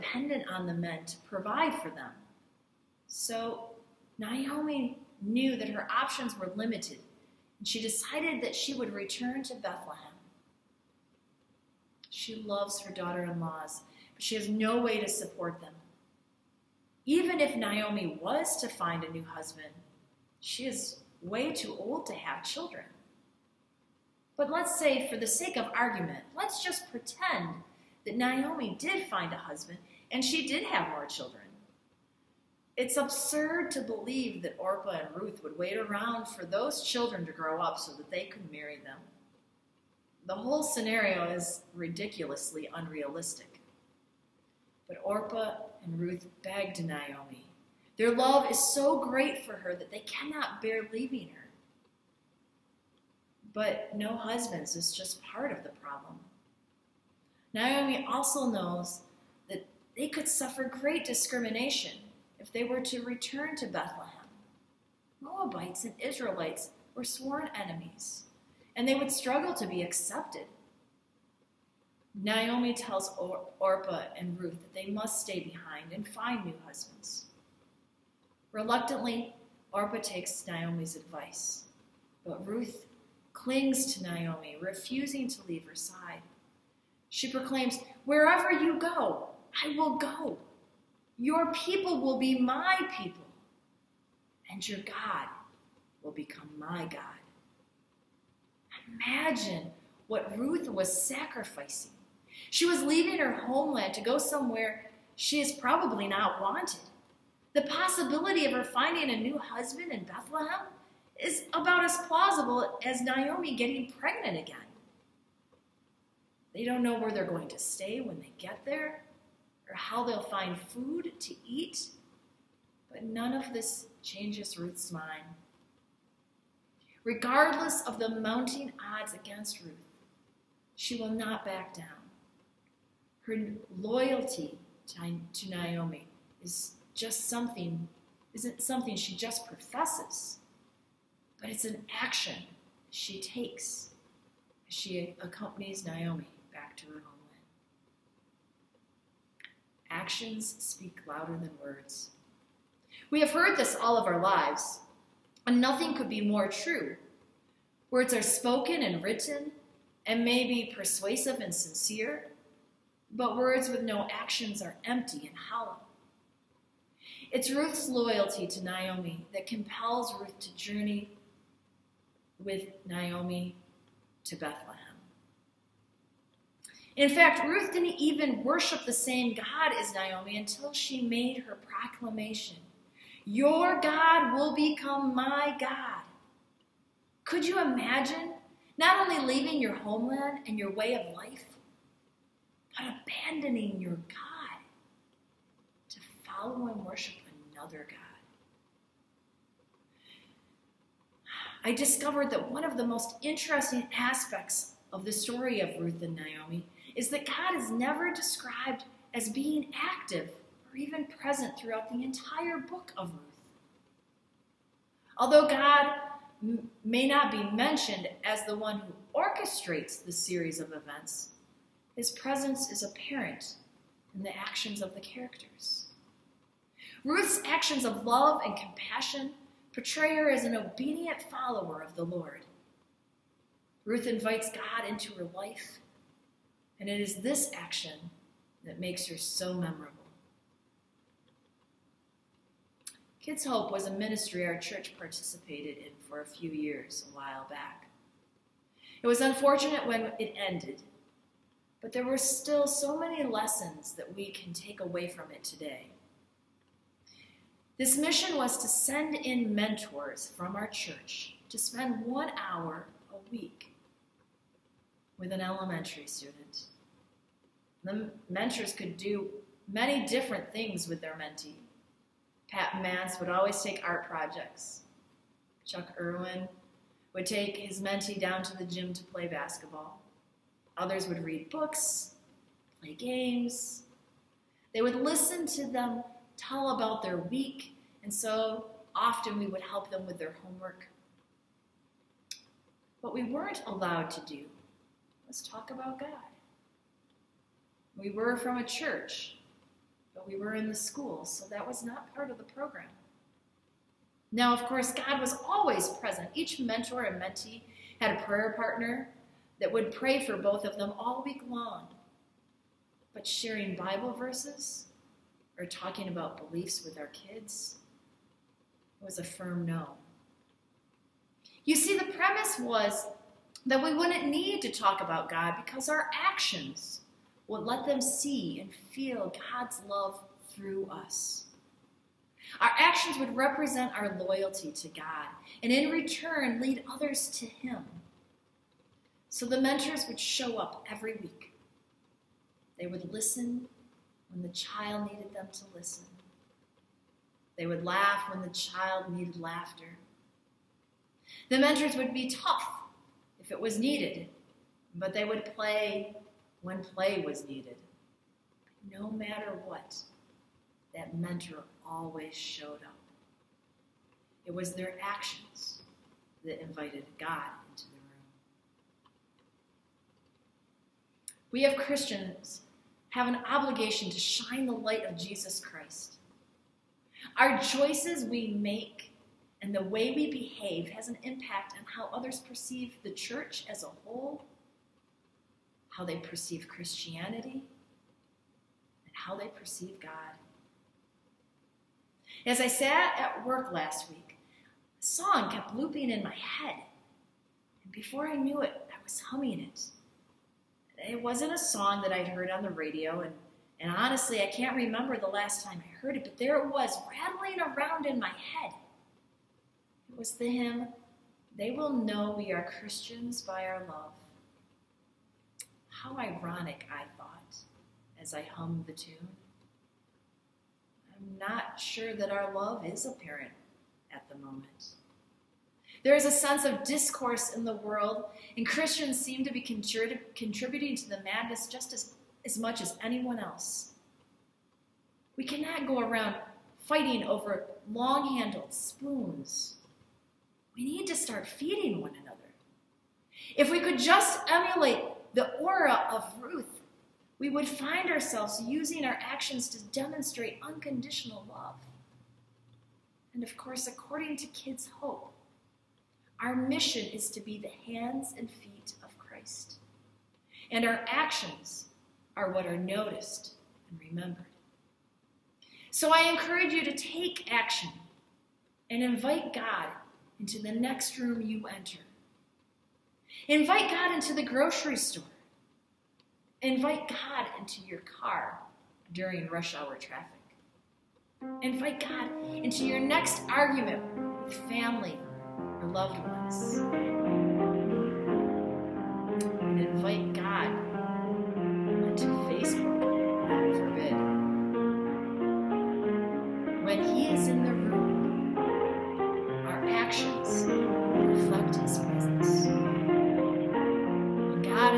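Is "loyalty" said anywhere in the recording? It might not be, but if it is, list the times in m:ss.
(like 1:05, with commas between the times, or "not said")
2:13, 2:47, 5:34.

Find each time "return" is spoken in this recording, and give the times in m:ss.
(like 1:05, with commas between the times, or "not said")
0:08, 1:03, 5:35.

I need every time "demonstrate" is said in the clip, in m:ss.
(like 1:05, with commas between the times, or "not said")
7:29.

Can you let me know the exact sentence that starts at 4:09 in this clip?
It was unfortunate when it ended but there were still so many lessons that we can take away from it today.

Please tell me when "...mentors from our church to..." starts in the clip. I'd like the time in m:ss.
4:19.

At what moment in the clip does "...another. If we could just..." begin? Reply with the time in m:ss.
7:22.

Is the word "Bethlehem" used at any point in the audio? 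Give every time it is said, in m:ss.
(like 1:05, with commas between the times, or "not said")
0:09, 1:03, 1:50, 2:54.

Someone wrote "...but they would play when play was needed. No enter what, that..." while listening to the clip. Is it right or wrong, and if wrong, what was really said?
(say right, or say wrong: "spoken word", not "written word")
wrong: "matter", not "enter".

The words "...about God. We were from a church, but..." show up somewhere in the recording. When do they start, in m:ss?
4:55.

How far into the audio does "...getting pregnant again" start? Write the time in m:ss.
1:53.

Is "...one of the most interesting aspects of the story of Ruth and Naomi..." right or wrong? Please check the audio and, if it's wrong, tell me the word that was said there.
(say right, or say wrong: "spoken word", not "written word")
right.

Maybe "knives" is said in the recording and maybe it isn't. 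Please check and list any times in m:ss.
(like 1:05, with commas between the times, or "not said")
not said.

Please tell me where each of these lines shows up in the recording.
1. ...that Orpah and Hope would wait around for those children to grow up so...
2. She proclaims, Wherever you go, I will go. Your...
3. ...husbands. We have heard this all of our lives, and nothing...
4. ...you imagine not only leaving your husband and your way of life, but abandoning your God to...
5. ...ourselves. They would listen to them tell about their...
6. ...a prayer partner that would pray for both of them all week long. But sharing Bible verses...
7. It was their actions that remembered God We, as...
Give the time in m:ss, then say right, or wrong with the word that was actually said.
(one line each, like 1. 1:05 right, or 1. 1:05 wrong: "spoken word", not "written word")
1. 0:34 wrong: "Ruth", not "Hope"
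2. 1:27 right
3. 2:31 wrong: "words", not "husbands"
4. 3:07 wrong: "homeland", not "husband"
5. 4:42 wrong: "games", not "ourselves"
6. 5:08 right
7. 6:04 wrong: "invited", not "remembered".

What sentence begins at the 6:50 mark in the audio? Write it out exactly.
It was the hymn, They Will Know We Are Christians by Our Love.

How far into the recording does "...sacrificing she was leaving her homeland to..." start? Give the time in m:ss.
1:41.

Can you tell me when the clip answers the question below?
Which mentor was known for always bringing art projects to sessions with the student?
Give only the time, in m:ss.
4:32.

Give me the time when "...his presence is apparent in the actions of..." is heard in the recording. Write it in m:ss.
3:41.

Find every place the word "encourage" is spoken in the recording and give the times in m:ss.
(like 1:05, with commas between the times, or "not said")
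7:46.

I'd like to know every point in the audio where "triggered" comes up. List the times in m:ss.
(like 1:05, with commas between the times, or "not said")
not said.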